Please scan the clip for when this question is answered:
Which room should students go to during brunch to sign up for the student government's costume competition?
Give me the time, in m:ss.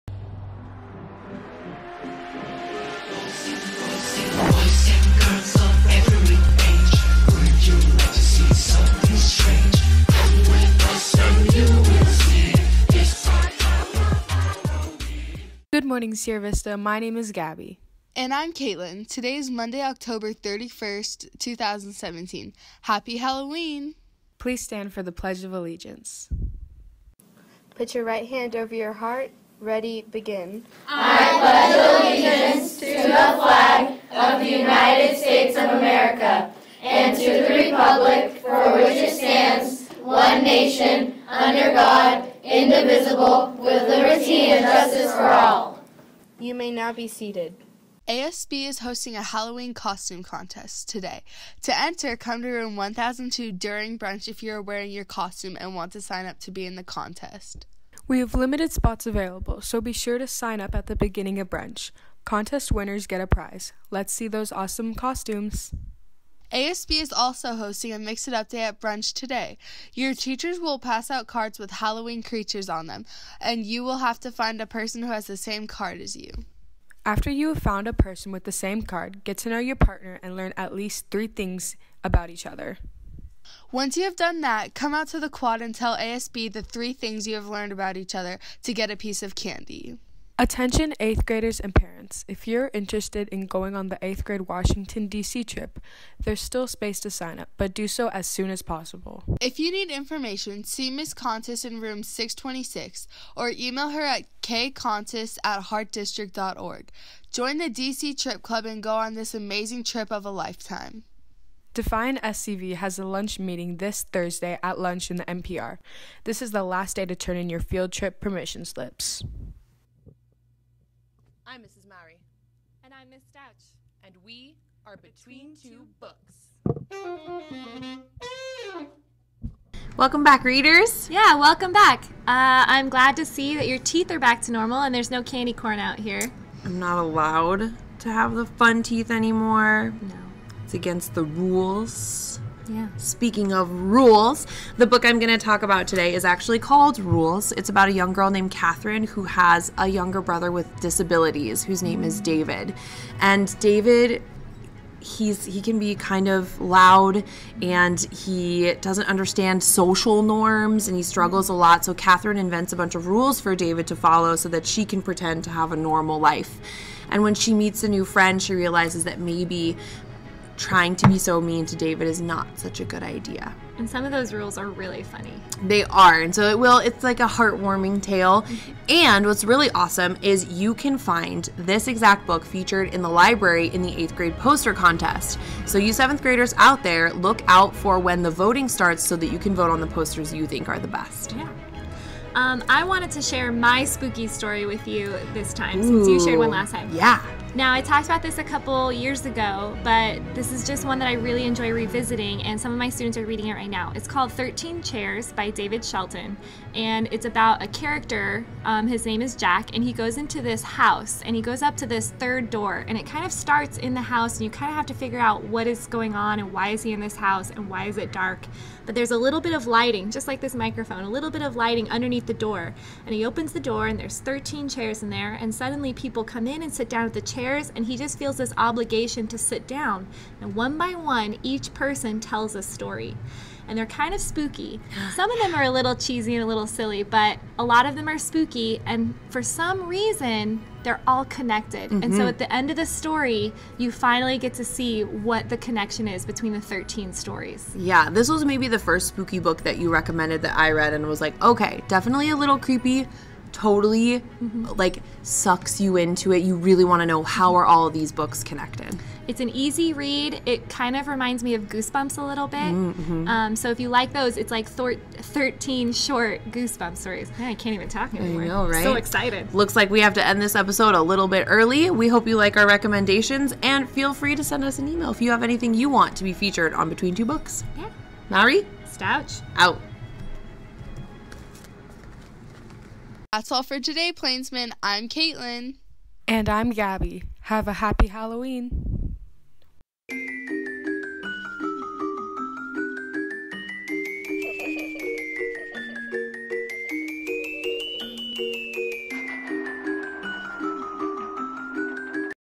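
0:52.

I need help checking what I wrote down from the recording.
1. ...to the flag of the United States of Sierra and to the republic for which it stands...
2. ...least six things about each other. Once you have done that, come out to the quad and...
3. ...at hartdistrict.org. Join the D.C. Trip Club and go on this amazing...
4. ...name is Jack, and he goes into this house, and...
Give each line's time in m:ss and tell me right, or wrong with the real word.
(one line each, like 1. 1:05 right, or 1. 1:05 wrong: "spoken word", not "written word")
1. 0:32 wrong: "America", not "Sierra"
2. 1:20 wrong: "three", not "six"
3. 1:45 right
4. 3:29 right.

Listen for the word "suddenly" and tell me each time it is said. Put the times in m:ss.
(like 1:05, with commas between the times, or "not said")
3:45.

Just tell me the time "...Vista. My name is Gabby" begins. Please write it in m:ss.
0:16.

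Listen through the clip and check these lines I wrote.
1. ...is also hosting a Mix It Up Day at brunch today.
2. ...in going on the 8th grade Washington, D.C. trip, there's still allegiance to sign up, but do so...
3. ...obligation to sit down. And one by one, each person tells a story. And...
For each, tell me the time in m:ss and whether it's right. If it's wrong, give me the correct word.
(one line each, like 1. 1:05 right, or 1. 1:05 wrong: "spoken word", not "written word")
1. 1:07 right
2. 1:33 wrong: "space", not "allegiance"
3. 3:48 right.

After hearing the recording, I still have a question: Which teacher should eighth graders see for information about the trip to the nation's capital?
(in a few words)
Ms. Contis.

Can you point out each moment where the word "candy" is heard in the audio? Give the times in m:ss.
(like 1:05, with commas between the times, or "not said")
1:29, 2:15.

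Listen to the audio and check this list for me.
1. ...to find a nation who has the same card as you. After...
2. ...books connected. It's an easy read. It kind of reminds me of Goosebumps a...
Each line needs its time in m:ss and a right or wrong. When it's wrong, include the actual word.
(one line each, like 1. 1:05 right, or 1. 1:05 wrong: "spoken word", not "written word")
1. 1:14 wrong: "person", not "nation"
2. 4:18 right.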